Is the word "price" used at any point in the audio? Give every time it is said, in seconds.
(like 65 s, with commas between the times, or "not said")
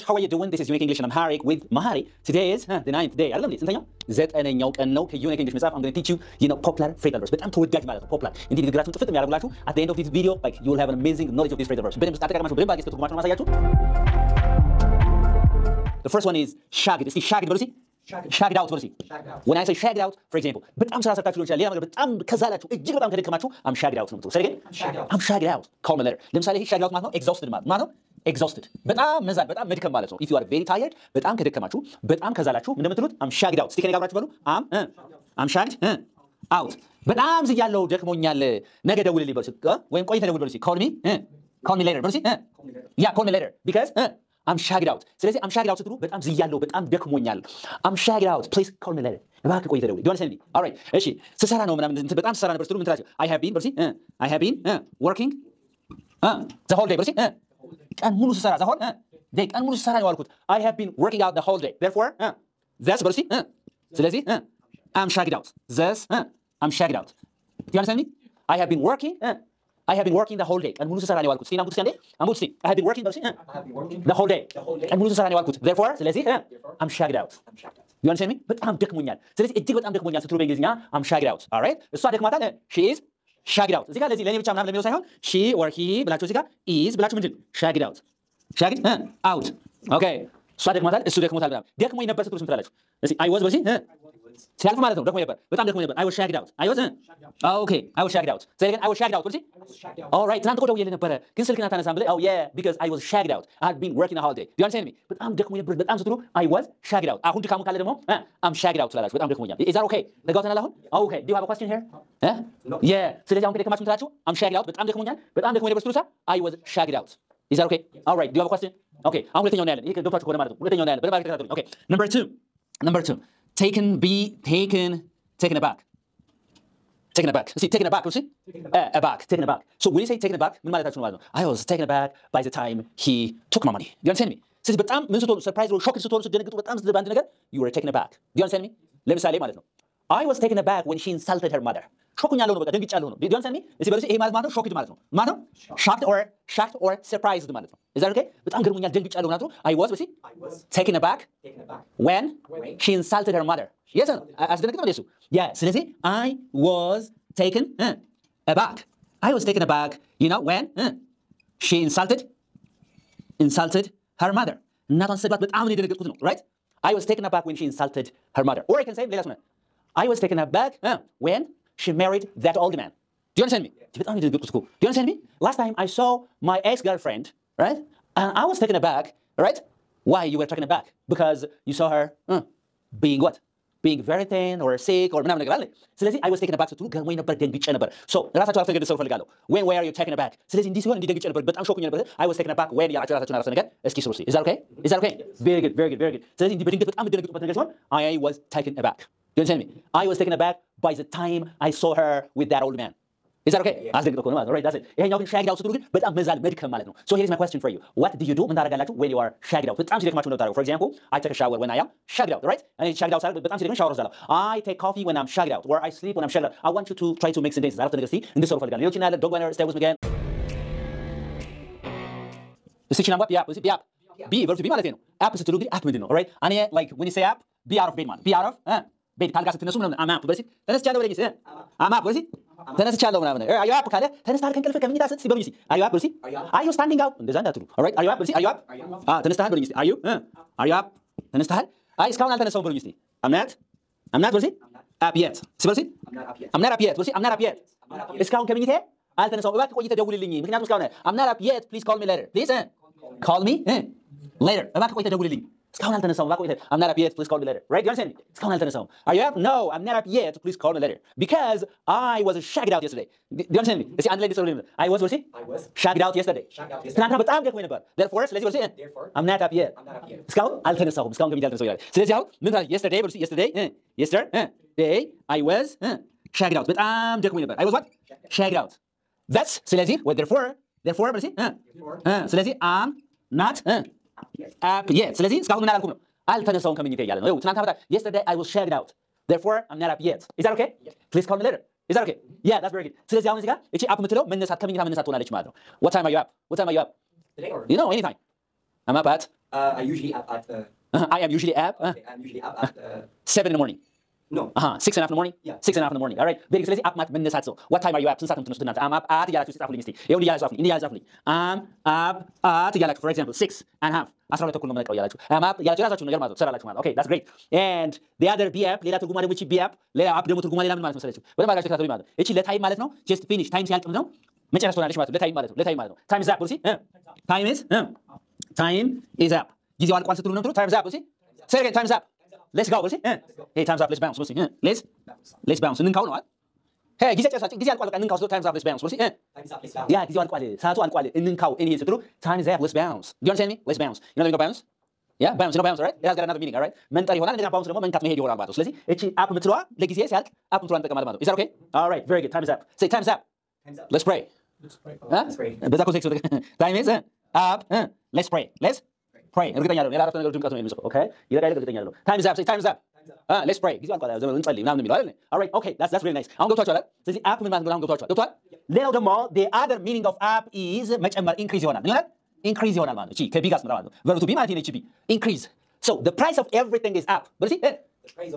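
376 s.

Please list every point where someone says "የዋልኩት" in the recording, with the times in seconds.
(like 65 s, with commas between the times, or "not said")
60 s, 71 s, 75 s.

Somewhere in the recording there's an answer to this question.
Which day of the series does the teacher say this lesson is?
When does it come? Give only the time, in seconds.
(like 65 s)
2 s.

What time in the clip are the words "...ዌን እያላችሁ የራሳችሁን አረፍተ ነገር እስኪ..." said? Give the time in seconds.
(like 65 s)
192 s.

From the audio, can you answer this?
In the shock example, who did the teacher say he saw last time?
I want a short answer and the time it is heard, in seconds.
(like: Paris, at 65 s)
my ex girlfriend, at 176 s.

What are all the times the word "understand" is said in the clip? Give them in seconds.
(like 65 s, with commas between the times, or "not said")
67 s, 78 s, 104 s, 343 s.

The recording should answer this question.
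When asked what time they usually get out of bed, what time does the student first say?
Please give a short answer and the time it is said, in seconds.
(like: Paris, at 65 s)
seven in the morning, at 303 s.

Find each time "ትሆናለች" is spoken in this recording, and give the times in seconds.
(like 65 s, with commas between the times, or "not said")
295 s, 324 s.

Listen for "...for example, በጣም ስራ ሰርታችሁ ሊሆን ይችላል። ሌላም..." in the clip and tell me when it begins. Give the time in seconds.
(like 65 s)
20 s.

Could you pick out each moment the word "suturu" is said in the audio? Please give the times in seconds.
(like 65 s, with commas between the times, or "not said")
105 s.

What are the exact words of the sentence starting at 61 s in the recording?
Therefore, that's በሉስቲ ስለዚህ I'm shagged out.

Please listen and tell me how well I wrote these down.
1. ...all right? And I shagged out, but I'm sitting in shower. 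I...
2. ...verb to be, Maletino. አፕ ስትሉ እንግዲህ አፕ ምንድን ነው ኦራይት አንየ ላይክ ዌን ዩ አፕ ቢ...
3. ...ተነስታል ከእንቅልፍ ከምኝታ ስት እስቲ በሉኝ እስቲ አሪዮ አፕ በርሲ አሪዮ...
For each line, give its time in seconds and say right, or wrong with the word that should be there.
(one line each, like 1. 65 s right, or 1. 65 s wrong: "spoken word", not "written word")
1. 212 s right
2. 224 s right
3. 234 s right.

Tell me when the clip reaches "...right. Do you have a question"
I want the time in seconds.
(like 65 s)
118 s.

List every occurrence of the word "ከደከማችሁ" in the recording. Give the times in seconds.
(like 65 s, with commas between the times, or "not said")
23 s, 31 s.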